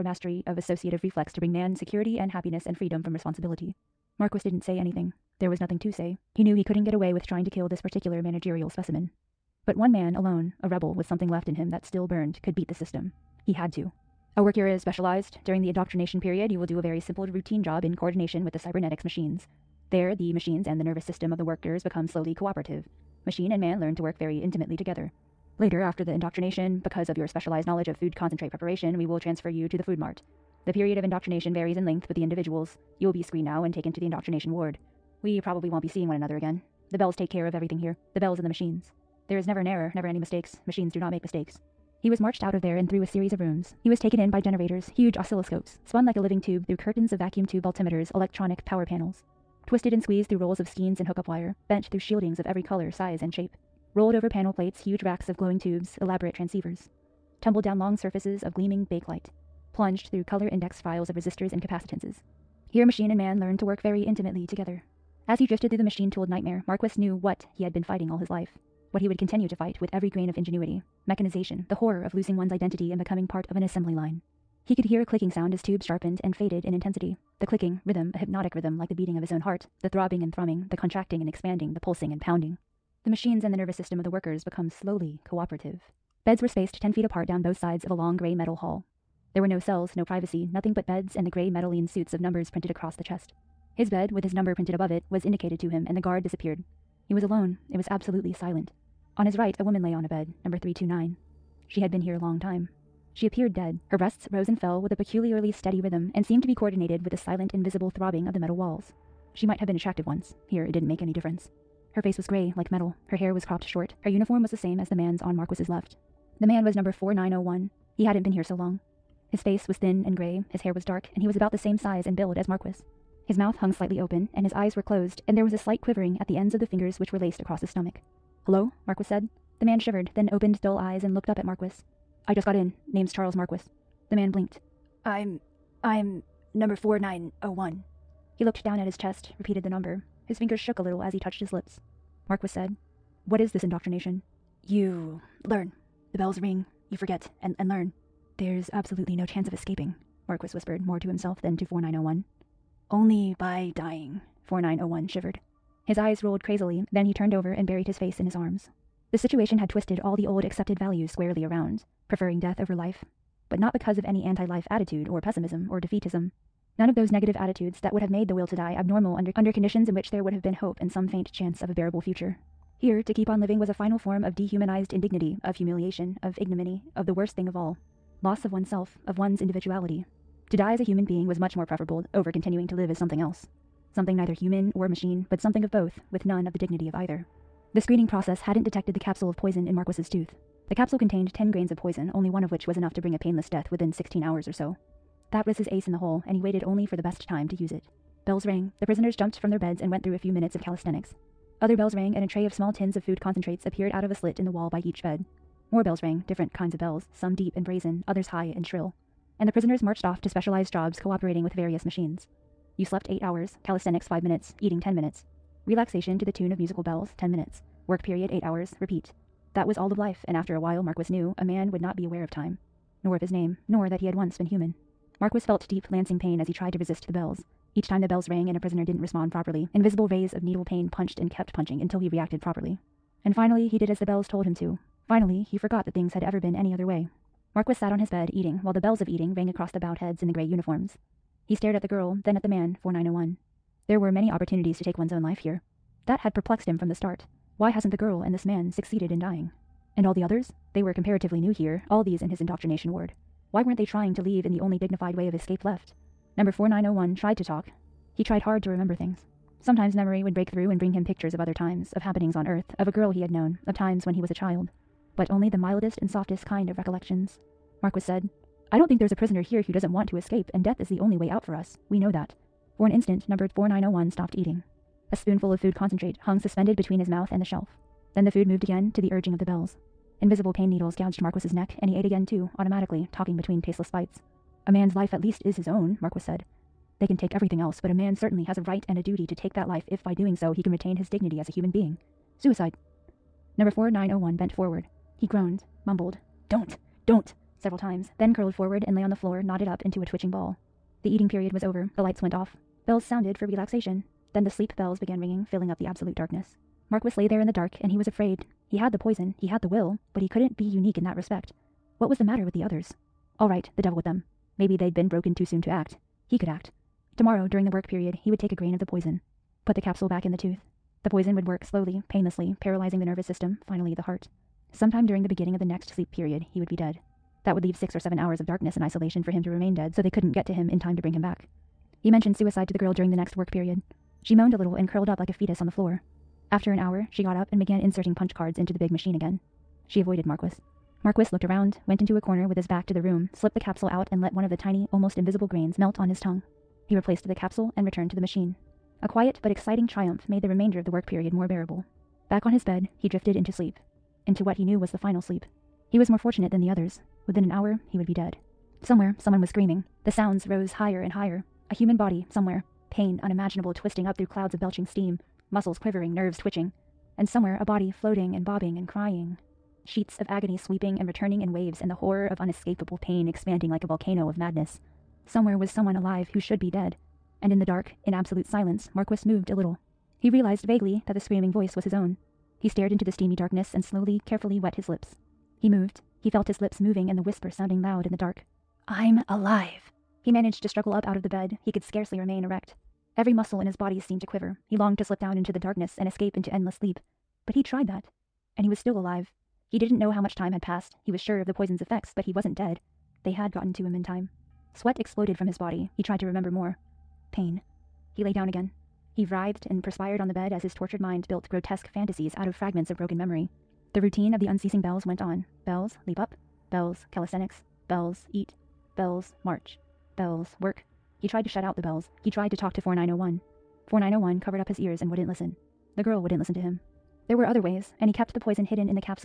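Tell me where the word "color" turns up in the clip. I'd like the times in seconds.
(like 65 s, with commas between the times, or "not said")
52 s, 60 s.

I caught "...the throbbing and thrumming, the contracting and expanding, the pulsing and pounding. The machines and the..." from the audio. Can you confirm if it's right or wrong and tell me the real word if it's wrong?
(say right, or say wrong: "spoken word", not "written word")
right.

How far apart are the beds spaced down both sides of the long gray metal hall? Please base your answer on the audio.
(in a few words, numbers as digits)
10 feet.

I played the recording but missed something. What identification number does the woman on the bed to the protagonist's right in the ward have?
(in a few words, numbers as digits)
329.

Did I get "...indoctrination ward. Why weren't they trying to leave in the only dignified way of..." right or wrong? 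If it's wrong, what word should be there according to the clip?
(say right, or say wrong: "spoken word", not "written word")
right.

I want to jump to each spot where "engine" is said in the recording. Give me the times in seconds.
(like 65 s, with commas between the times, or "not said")
not said.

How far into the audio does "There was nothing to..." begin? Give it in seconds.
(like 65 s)
5 s.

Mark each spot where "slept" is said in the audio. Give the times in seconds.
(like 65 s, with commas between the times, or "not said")
212 s.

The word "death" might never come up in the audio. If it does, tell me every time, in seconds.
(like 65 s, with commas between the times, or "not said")
162 s, 193 s, 270 s.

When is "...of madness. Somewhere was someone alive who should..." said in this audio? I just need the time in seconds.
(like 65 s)
374 s.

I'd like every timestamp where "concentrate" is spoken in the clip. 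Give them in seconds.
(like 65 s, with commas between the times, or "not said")
28 s, 203 s, 275 s.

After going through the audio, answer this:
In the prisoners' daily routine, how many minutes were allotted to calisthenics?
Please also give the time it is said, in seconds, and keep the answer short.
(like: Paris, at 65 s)
5, at 214 s.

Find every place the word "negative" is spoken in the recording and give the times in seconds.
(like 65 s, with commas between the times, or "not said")
167 s.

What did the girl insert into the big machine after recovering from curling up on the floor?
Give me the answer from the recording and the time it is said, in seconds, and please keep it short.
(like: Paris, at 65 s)
punch cards, at 338 s.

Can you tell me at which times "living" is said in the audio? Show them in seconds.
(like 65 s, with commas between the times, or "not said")
46 s, 173 s.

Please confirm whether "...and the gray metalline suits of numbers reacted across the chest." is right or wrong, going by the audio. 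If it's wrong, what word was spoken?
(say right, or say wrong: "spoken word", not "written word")
wrong: "printed", not "reacted".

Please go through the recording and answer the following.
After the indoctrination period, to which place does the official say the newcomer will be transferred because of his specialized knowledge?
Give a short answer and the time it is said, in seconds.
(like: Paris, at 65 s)
the food mart, at 29 s.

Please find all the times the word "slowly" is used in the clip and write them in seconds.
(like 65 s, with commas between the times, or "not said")
22 s, 84 s, 321 s, 383 s.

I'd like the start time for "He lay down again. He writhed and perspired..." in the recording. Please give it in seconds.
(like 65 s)
408 s.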